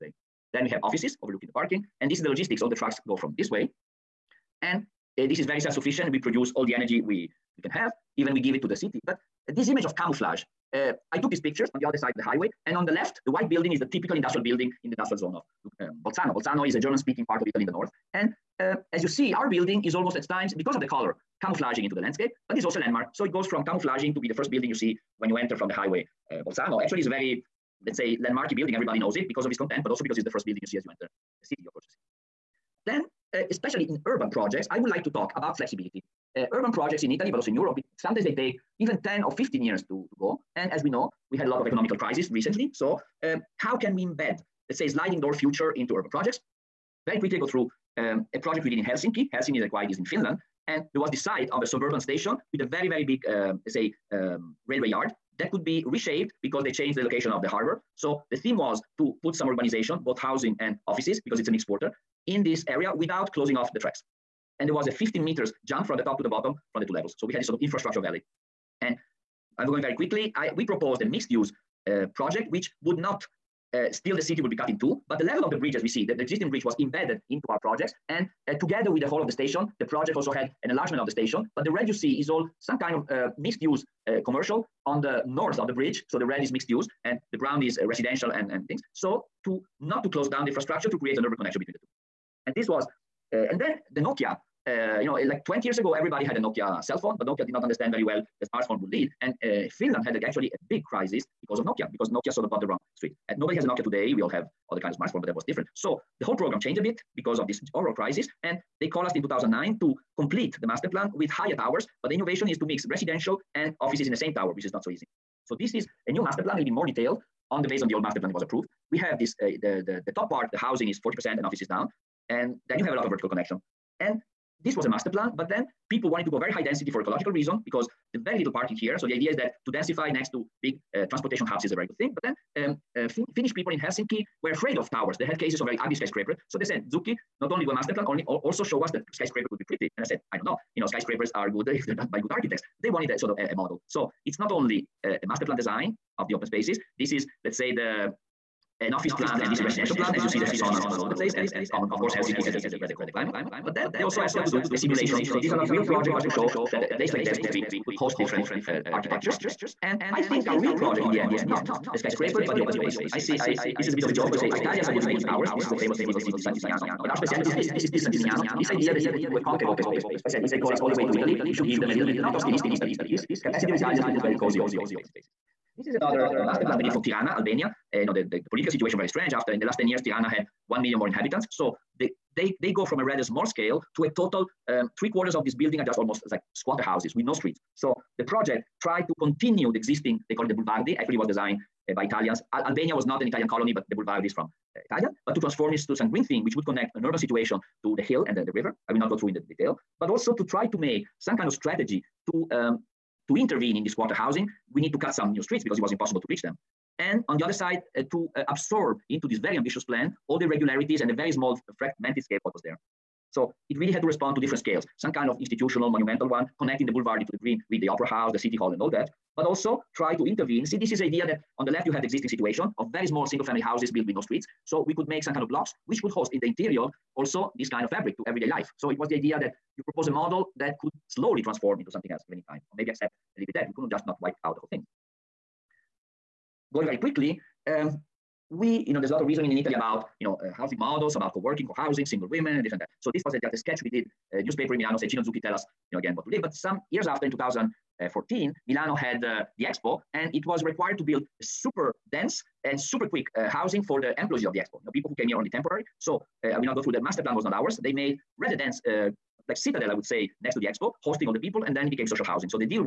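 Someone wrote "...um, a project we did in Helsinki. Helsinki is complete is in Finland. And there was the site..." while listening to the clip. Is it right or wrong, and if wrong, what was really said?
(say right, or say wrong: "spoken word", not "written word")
wrong: "quite", not "complete".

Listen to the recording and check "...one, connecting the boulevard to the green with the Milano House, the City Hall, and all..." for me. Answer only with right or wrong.
wrong.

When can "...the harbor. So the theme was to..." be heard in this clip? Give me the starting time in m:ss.
0:57.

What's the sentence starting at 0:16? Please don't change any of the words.
Bolzano is a German speaking part of Italy in the north.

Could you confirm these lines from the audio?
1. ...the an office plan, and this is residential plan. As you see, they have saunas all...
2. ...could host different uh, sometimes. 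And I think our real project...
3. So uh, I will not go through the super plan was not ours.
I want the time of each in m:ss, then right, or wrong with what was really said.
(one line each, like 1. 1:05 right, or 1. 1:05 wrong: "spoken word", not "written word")
1. 2:27 right
2. 2:37 wrong: "architectures", not "sometimes"
3. 4:16 wrong: "master", not "super".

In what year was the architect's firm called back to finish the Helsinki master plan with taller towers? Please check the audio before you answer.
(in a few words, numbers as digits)
2009.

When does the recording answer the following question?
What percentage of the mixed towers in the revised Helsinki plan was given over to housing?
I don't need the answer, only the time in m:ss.
2:01.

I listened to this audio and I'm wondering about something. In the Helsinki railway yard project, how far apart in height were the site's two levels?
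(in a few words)
50 meters.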